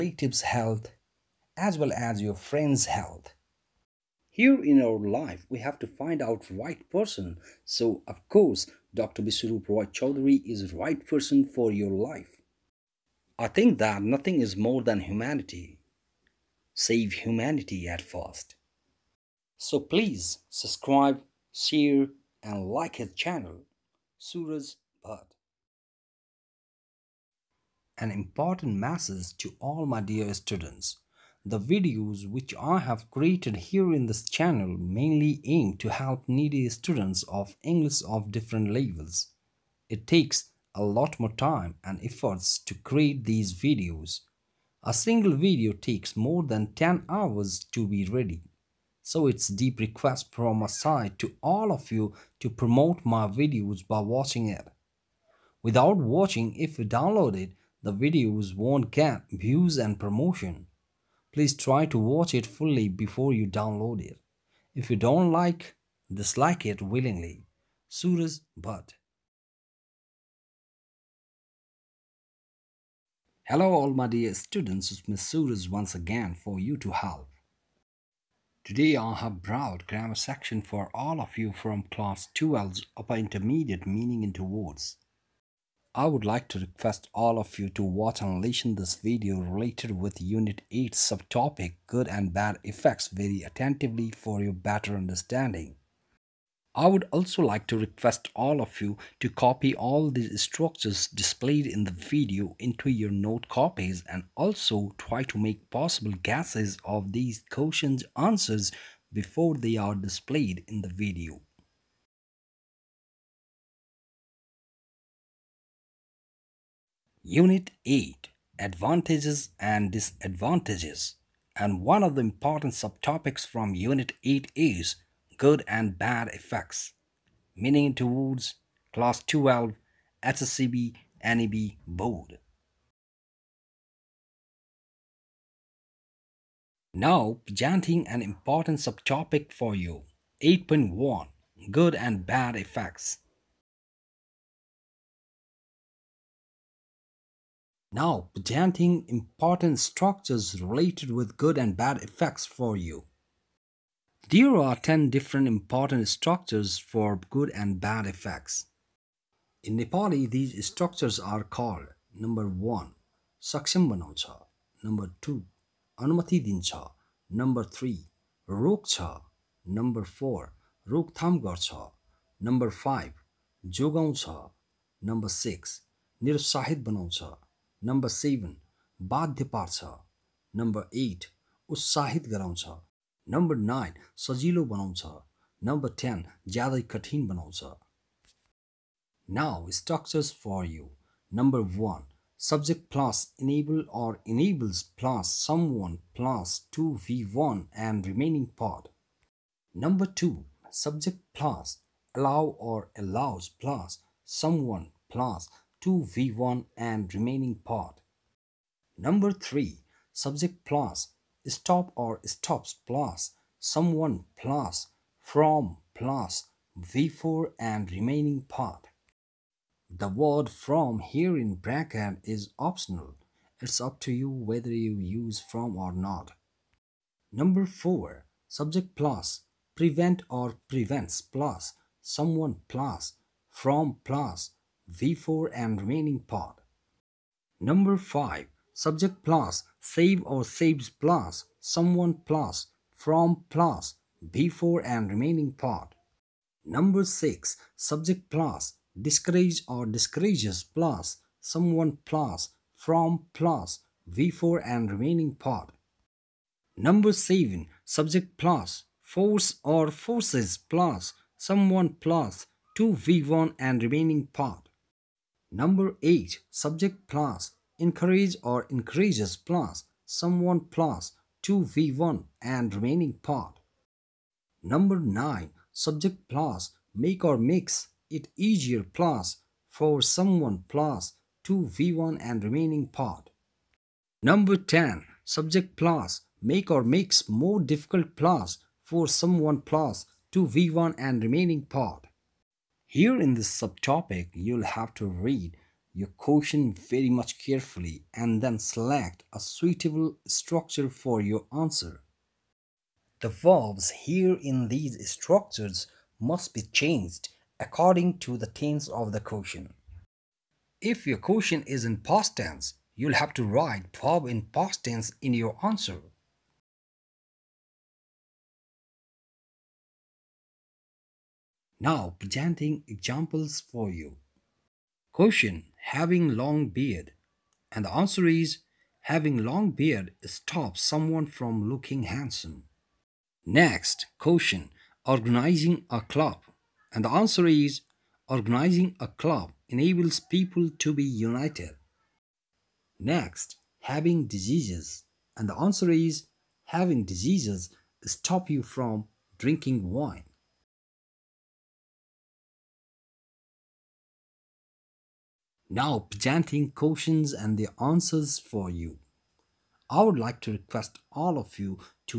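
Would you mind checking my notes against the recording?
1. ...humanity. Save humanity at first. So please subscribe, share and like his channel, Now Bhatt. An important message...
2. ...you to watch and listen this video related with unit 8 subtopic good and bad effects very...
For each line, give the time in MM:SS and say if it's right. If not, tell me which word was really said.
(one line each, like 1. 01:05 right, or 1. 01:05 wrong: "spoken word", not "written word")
1. 00:15 wrong: "Suraj", not "Now"
2. 01:27 right.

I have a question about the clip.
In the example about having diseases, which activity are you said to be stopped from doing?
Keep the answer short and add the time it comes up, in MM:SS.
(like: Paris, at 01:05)
drinking wine, at 05:49.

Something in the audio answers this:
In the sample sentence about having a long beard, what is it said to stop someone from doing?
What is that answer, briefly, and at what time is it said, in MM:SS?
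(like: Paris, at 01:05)
looking handsome, at 05:31.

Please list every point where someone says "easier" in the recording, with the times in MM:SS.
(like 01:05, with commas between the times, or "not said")
04:38.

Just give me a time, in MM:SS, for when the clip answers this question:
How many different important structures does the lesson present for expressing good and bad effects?
02:34.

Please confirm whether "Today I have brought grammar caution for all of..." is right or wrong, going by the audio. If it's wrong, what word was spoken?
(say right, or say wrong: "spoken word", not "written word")
wrong: "section", not "caution".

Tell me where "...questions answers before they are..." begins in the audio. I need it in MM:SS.
01:47.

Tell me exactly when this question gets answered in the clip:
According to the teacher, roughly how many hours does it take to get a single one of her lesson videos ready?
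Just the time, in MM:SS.
00:46.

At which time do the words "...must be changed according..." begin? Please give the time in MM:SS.
05:06.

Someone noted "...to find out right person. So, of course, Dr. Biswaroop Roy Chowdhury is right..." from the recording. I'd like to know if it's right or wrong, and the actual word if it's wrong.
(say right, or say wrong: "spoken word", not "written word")
right.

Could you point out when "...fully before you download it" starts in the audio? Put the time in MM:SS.
01:02.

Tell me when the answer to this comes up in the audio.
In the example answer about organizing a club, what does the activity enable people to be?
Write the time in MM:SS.
05:41.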